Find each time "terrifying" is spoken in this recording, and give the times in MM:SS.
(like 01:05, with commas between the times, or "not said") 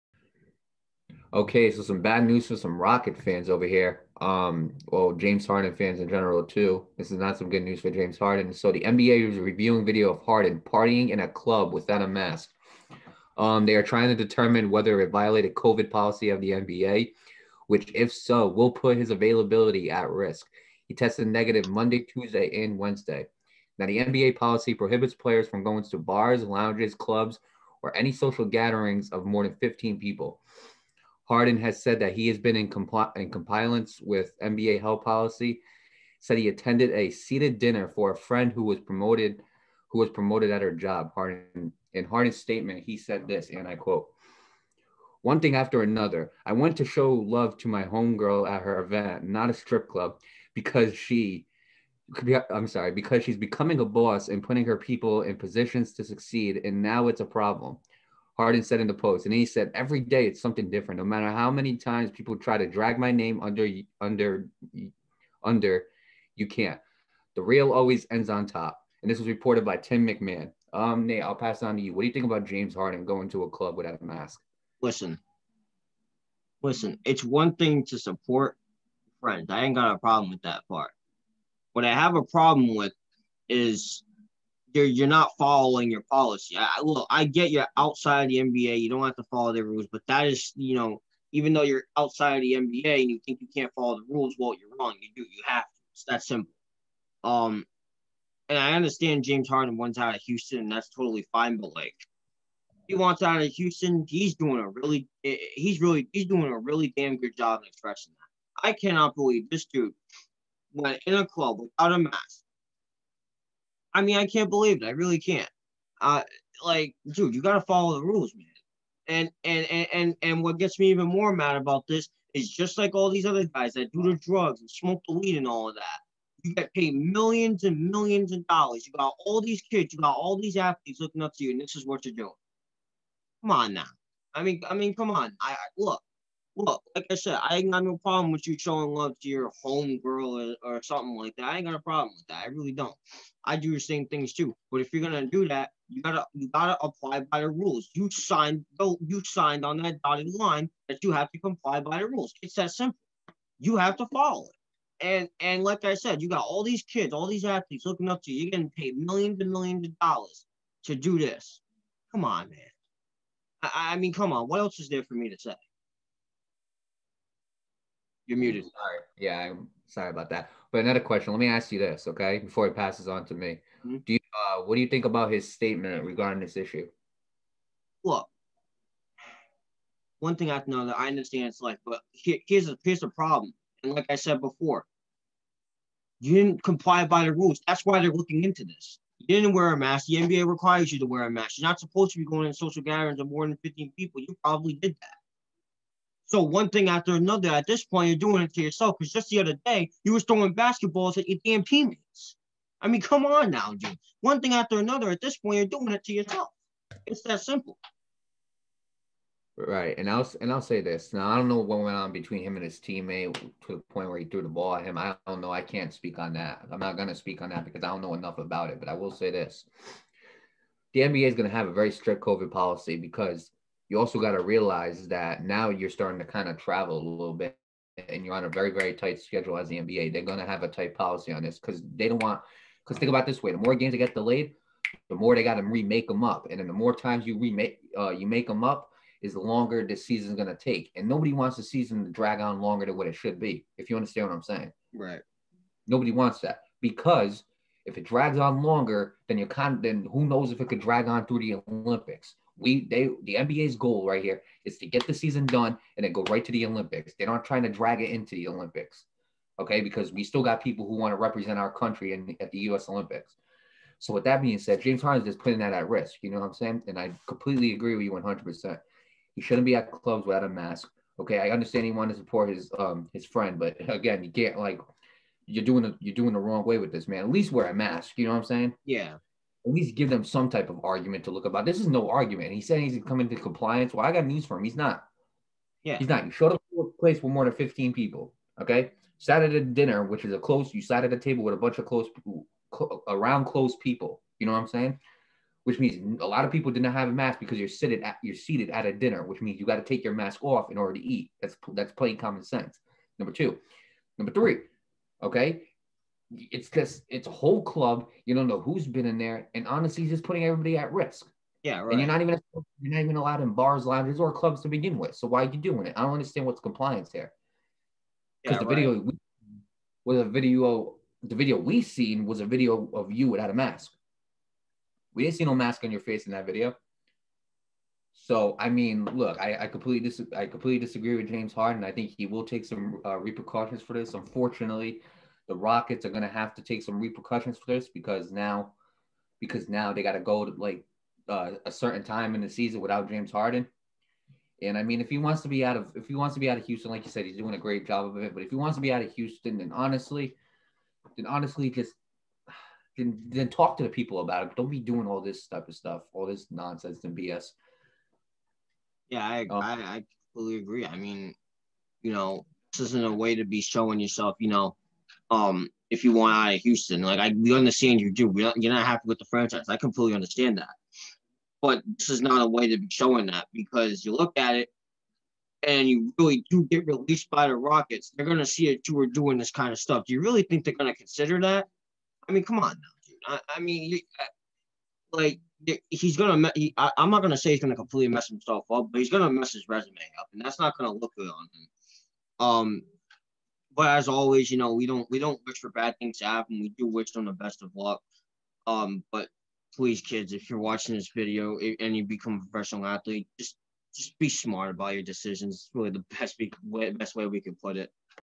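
not said.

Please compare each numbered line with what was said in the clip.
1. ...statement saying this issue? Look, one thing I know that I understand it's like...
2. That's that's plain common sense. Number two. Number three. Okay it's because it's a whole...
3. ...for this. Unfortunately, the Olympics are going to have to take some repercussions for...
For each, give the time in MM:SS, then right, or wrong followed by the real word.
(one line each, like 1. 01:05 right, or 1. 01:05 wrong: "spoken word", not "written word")
1. 02:55 wrong: "regarding", not "saying"
2. 05:01 right
3. 05:33 wrong: "Rockets", not "Olympics".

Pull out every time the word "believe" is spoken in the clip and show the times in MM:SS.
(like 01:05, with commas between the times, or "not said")
01:49, 01:54.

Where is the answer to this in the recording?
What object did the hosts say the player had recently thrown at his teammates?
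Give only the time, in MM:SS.
03:20.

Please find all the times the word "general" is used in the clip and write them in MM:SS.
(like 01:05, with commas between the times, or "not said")
00:06.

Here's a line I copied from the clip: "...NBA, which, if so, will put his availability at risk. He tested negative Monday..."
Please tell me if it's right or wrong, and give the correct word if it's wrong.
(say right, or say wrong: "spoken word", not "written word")
right.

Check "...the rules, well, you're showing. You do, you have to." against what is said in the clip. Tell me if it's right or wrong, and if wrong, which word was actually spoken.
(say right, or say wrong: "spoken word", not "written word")
wrong: "wrong", not "showing".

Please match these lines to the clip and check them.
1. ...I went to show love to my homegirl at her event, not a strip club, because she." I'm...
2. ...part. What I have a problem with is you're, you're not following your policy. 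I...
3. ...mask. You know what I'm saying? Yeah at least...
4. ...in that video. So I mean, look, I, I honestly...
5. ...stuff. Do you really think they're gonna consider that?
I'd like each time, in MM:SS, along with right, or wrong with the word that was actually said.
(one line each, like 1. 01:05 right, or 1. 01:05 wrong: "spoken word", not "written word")
1. 00:46 right
2. 01:20 right
3. 04:37 right
4. 05:26 wrong: "completely", not "honestly"
5. 06:19 right.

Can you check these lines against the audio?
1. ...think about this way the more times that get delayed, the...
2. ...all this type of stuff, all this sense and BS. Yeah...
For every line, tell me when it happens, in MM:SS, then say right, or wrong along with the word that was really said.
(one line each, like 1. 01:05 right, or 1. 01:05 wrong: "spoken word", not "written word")
1. 03:52 wrong: "games", not "times"
2. 05:55 wrong: "nonsense", not "sense".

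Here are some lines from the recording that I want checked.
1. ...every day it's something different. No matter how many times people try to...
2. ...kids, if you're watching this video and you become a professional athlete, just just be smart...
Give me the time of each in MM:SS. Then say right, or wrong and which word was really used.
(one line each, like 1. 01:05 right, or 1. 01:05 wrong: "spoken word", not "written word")
1. 00:59 right
2. 06:40 right.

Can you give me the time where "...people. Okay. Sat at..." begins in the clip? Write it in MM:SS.
04:47.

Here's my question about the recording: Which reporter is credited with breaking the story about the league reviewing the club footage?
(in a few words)
Tim McMahon.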